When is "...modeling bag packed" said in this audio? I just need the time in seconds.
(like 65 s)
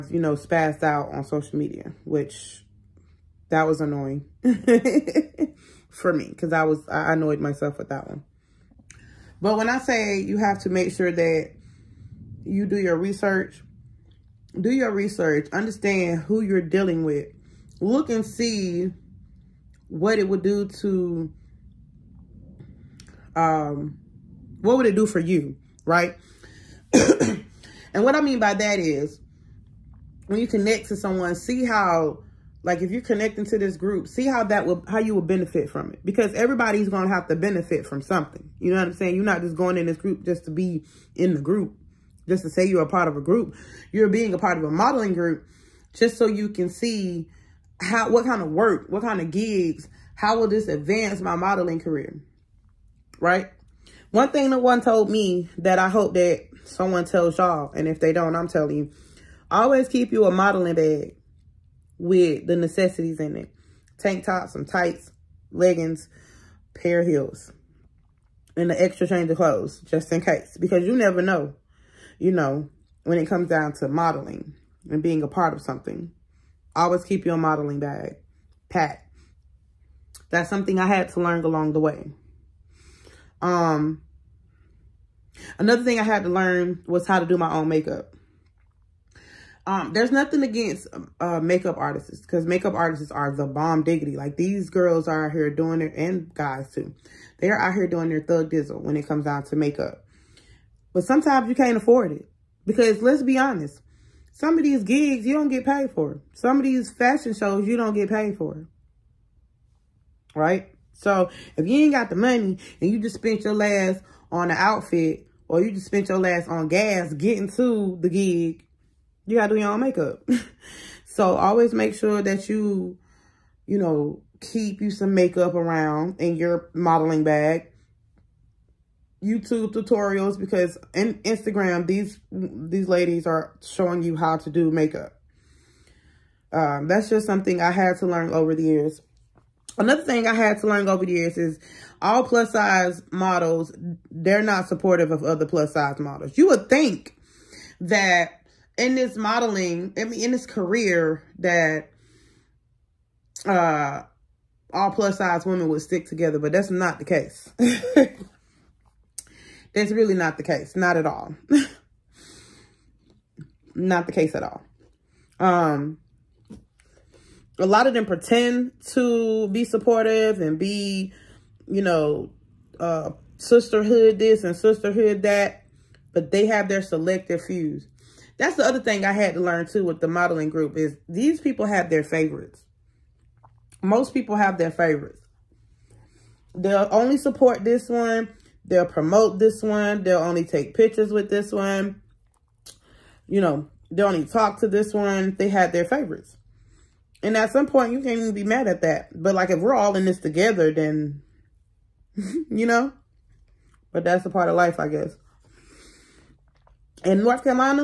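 77 s.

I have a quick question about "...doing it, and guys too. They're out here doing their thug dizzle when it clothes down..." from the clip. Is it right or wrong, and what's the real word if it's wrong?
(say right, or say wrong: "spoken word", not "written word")
wrong: "comes", not "clothes".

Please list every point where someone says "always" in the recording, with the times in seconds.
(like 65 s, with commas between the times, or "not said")
59 s, 76 s, 121 s.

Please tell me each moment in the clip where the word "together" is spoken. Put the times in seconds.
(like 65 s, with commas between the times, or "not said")
156 s, 200 s.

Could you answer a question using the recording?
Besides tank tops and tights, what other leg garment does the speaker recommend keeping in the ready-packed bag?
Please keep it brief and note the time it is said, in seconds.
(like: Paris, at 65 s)
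leggings, at 65 s.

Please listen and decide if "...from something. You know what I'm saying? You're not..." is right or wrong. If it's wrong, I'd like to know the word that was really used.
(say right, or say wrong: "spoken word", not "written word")
right.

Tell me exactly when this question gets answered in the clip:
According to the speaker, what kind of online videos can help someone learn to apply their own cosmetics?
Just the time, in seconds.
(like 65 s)
129 s.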